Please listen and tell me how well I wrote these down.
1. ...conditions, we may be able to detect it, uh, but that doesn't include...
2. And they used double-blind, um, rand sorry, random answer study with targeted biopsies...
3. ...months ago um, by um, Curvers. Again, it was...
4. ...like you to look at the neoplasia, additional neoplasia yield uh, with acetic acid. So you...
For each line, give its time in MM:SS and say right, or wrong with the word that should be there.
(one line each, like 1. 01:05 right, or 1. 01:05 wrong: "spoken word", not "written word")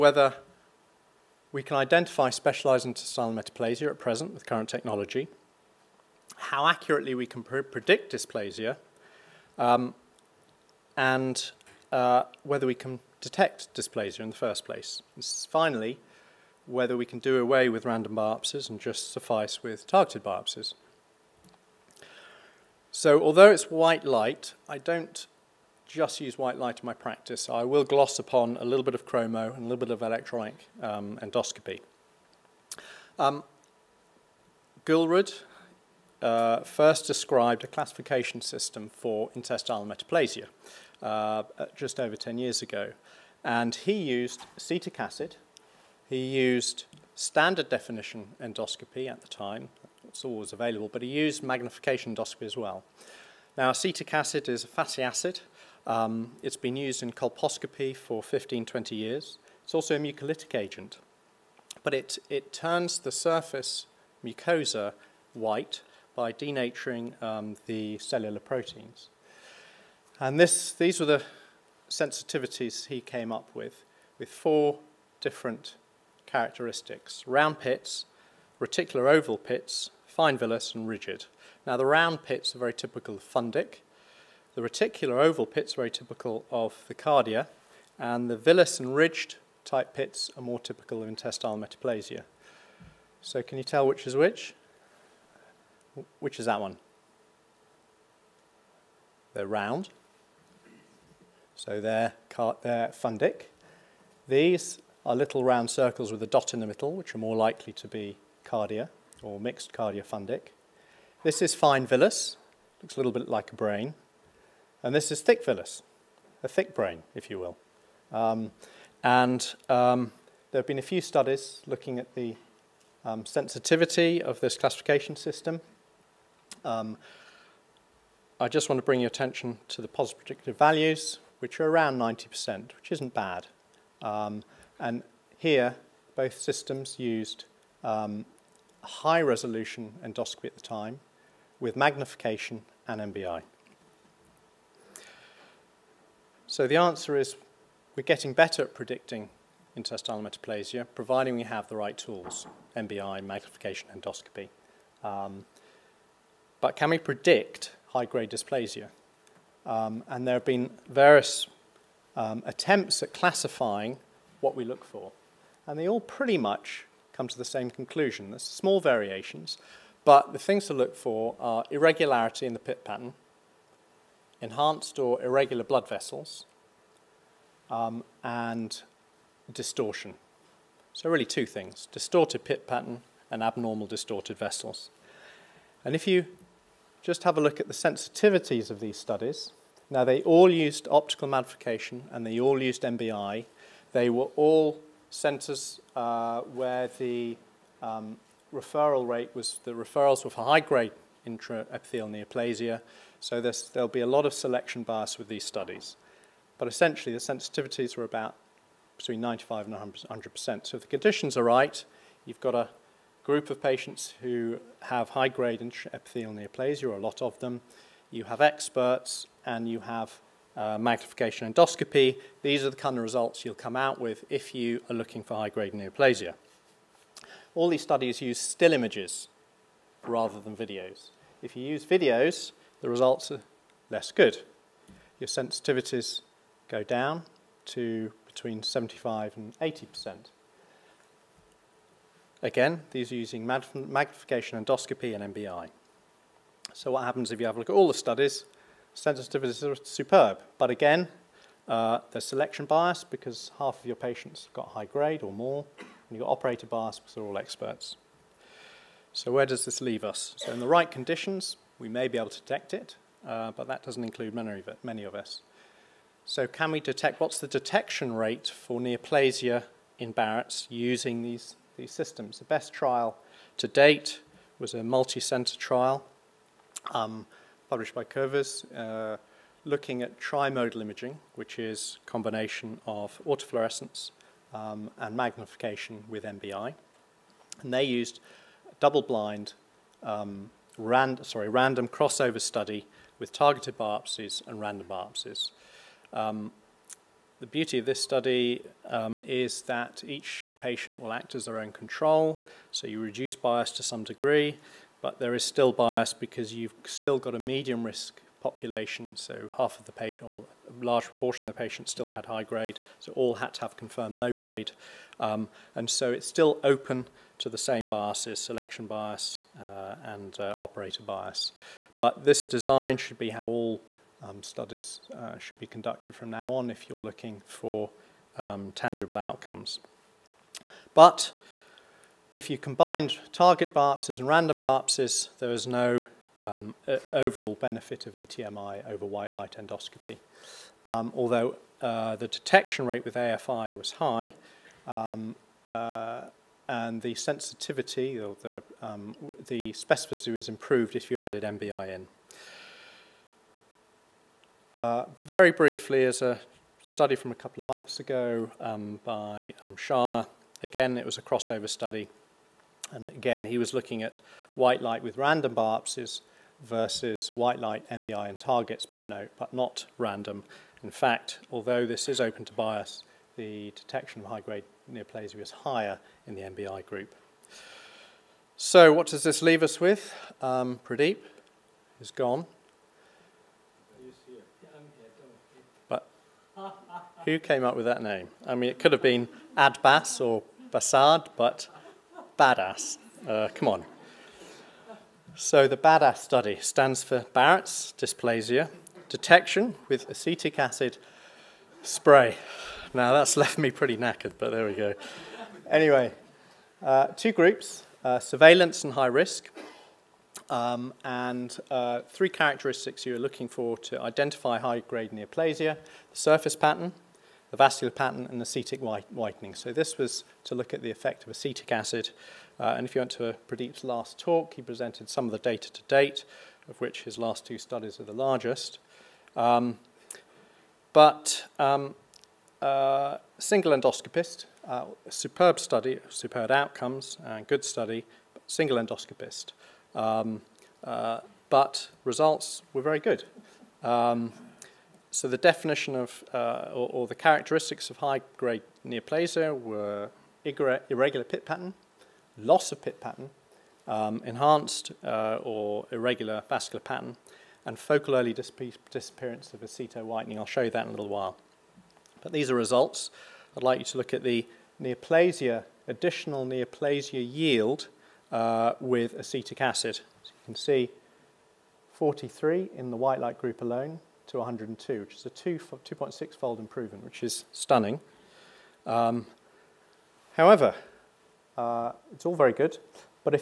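1. 04:20 right
2. 04:47 wrong: "crossover", not "answer"
3. 05:57 wrong: "Sharma", not "Curvers"
4. 07:43 right.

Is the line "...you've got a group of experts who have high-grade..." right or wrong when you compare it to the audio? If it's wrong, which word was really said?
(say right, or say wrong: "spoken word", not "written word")
wrong: "patients", not "experts".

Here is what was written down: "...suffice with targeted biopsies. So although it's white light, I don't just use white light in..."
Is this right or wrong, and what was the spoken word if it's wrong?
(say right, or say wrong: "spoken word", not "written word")
right.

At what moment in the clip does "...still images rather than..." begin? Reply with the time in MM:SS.
03:48.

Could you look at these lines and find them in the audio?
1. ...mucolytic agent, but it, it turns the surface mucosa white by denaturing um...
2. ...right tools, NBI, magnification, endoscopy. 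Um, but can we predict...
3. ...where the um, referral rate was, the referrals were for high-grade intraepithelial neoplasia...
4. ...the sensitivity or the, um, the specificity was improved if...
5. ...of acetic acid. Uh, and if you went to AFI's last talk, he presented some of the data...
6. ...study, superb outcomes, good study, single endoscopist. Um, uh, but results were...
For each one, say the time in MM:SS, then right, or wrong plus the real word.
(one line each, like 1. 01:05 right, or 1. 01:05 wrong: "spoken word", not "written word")
1. 00:59 right
2. 02:31 right
3. 03:16 right
4. 05:47 right
5. 07:01 wrong: "Pradeep", not "AFI"
6. 07:15 right.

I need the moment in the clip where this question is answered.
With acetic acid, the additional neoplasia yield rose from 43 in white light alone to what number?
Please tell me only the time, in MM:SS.
07:54.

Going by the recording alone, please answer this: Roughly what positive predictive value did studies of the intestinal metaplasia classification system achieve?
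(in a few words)
90%.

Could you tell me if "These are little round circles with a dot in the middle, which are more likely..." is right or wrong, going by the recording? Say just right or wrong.
right.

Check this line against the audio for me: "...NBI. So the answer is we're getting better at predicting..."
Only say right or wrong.
right.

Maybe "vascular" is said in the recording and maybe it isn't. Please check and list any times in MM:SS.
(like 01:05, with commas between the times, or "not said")
06:57, 07:36.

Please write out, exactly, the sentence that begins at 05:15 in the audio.
Um, and so it's still open to the same biases, selection bias uh, and uh, operator bias.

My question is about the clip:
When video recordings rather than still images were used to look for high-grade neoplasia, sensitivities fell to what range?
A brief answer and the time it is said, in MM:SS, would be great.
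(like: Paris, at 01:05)
75 to 80 percent, at 03:58.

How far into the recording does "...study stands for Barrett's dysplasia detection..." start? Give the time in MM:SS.
06:36.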